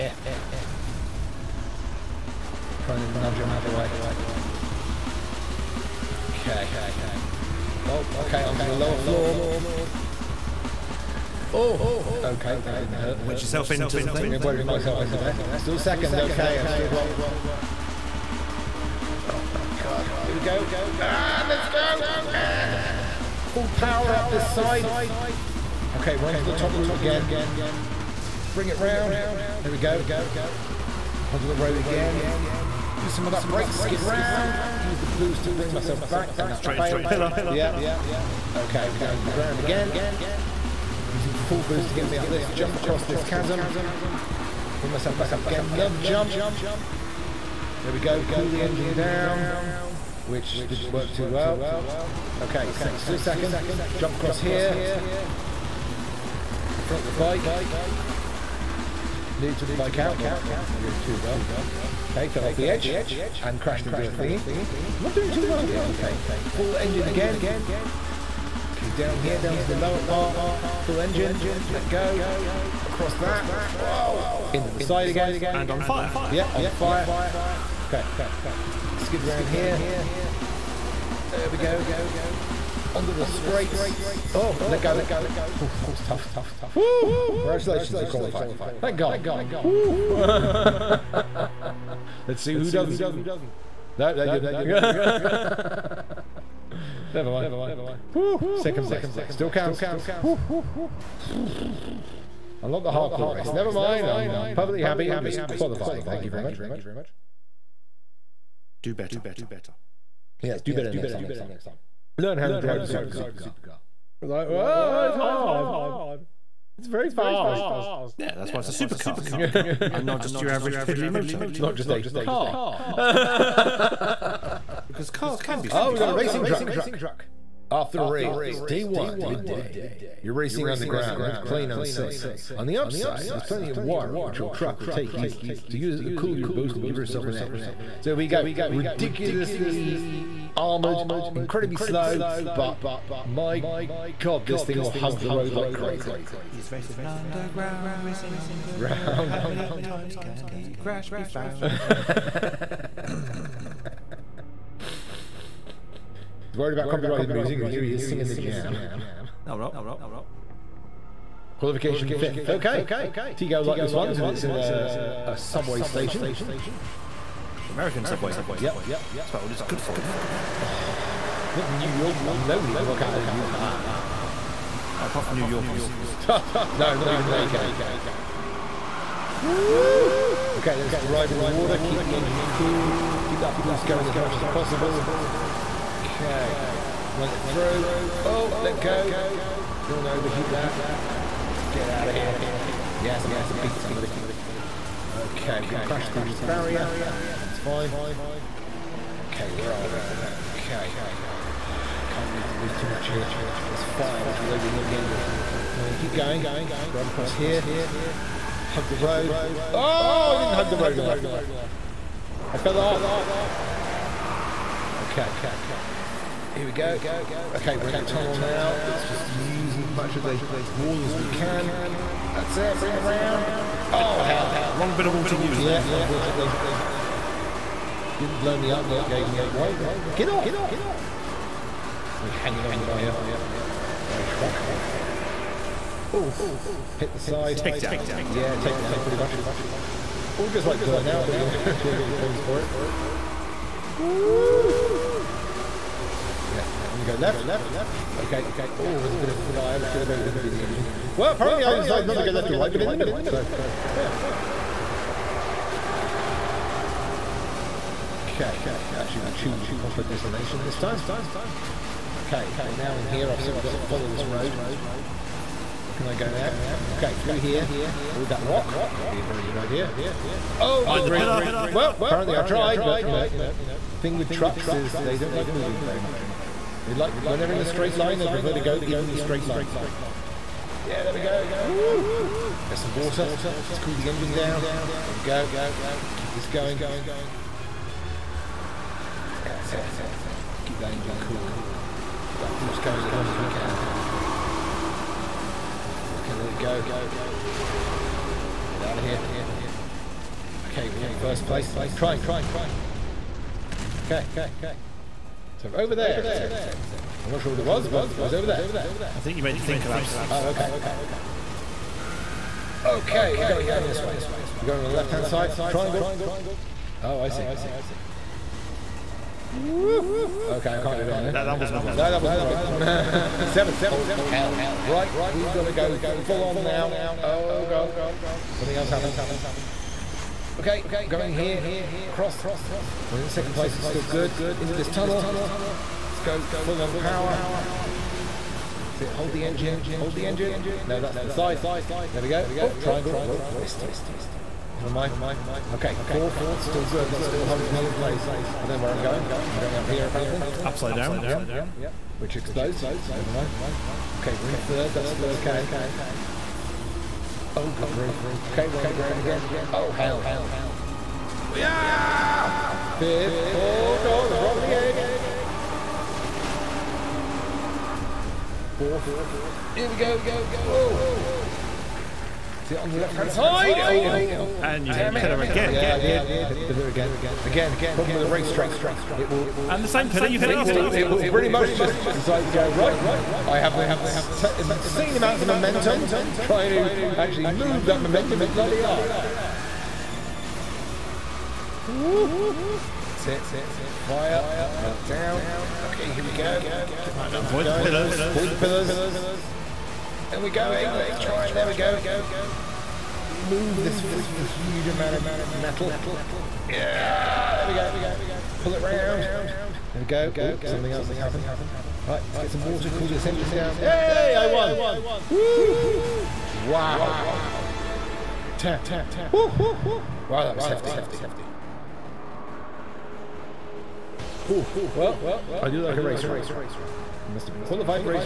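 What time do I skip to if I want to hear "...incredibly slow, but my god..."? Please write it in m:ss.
2:21.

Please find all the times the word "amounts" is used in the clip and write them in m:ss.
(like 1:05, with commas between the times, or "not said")
6:25, 6:44.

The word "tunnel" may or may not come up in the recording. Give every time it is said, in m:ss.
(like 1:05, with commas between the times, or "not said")
3:38, 5:34.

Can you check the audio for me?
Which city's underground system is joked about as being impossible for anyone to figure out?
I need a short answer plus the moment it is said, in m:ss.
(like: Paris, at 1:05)
New York, at 2:51.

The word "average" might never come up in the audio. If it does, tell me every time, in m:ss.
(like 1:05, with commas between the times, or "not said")
2:00.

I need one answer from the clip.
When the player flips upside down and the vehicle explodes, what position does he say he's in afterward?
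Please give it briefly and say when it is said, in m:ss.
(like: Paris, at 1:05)
Third, at 5:54.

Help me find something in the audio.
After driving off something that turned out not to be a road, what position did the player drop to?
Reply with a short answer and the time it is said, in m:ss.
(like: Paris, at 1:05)
Seventh, at 5:23.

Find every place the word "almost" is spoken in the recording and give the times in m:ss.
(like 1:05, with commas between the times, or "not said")
not said.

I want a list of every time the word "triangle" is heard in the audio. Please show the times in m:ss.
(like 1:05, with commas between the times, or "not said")
5:01, 5:15, 5:42.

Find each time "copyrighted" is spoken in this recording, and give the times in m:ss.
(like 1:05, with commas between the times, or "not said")
2:36.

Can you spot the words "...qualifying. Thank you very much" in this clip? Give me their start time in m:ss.
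1:45.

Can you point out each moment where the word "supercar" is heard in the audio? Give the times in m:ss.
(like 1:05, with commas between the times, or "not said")
1:52, 1:58.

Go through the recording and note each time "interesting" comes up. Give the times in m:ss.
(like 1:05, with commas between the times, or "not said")
not said.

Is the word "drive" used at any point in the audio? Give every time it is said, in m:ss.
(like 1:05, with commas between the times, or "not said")
1:52, 3:01, 3:26.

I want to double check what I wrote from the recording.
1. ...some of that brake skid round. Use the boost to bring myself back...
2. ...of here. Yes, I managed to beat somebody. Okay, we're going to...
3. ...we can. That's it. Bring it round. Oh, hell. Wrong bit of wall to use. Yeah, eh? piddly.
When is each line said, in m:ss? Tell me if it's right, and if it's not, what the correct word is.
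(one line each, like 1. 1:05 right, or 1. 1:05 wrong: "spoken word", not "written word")
1. 0:33 right
2. 3:12 right
3. 3:41 wrong: "unfortunately", not "piddly".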